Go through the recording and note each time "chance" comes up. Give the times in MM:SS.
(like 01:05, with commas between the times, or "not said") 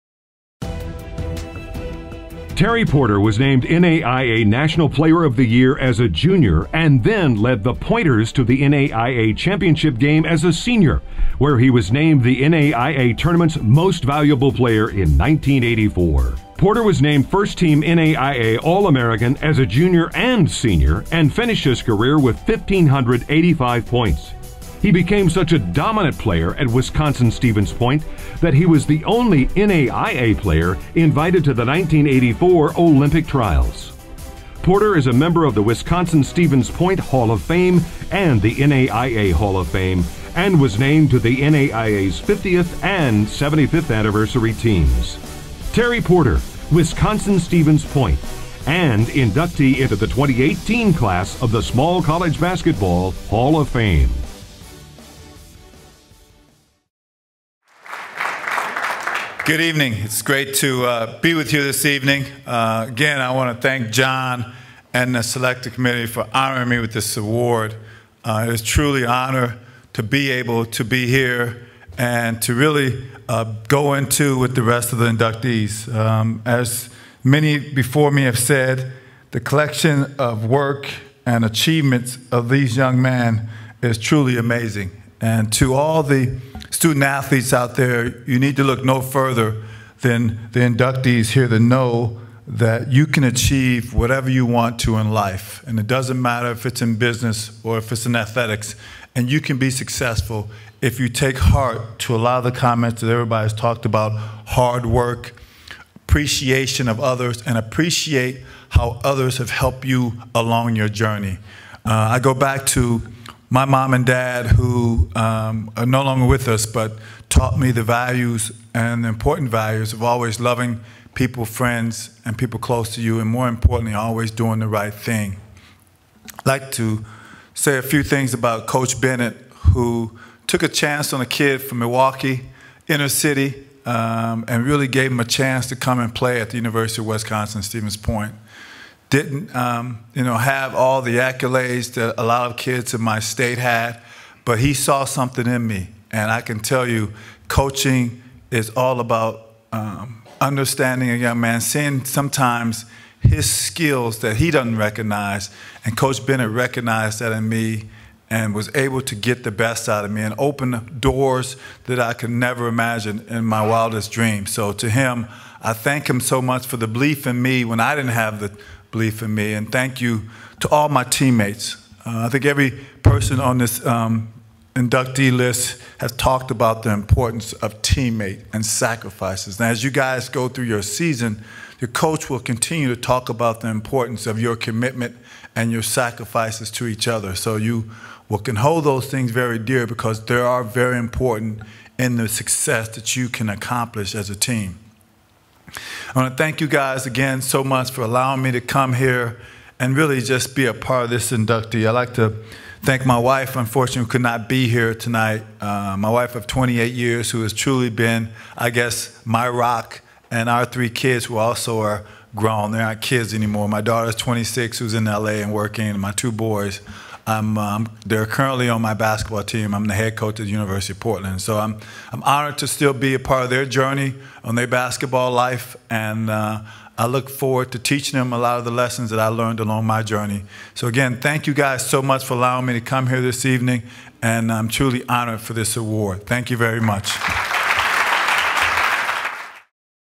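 02:10, 02:15.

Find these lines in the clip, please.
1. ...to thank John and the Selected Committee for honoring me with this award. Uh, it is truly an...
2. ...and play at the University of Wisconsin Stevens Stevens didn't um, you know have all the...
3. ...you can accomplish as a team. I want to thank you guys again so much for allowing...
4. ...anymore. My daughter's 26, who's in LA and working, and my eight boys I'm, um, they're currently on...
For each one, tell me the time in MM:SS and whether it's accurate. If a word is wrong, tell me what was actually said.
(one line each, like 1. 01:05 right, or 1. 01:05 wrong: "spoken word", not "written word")
1. 01:03 right
2. 02:15 wrong: "Point", not "Stevens"
3. 03:13 right
4. 03:33 wrong: "two", not "eight".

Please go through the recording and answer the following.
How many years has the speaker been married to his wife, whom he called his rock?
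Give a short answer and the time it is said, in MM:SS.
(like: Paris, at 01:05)
28, at 03:26.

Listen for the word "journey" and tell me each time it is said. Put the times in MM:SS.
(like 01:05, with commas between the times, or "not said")
01:50, 03:43, 03:50.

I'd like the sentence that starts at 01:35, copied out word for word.
And it doesn't matter if it's in business or if it's in athletics.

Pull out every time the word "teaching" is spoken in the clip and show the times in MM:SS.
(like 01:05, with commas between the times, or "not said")
03:47.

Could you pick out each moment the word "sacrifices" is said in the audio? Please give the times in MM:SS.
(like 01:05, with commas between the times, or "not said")
02:58, 03:05.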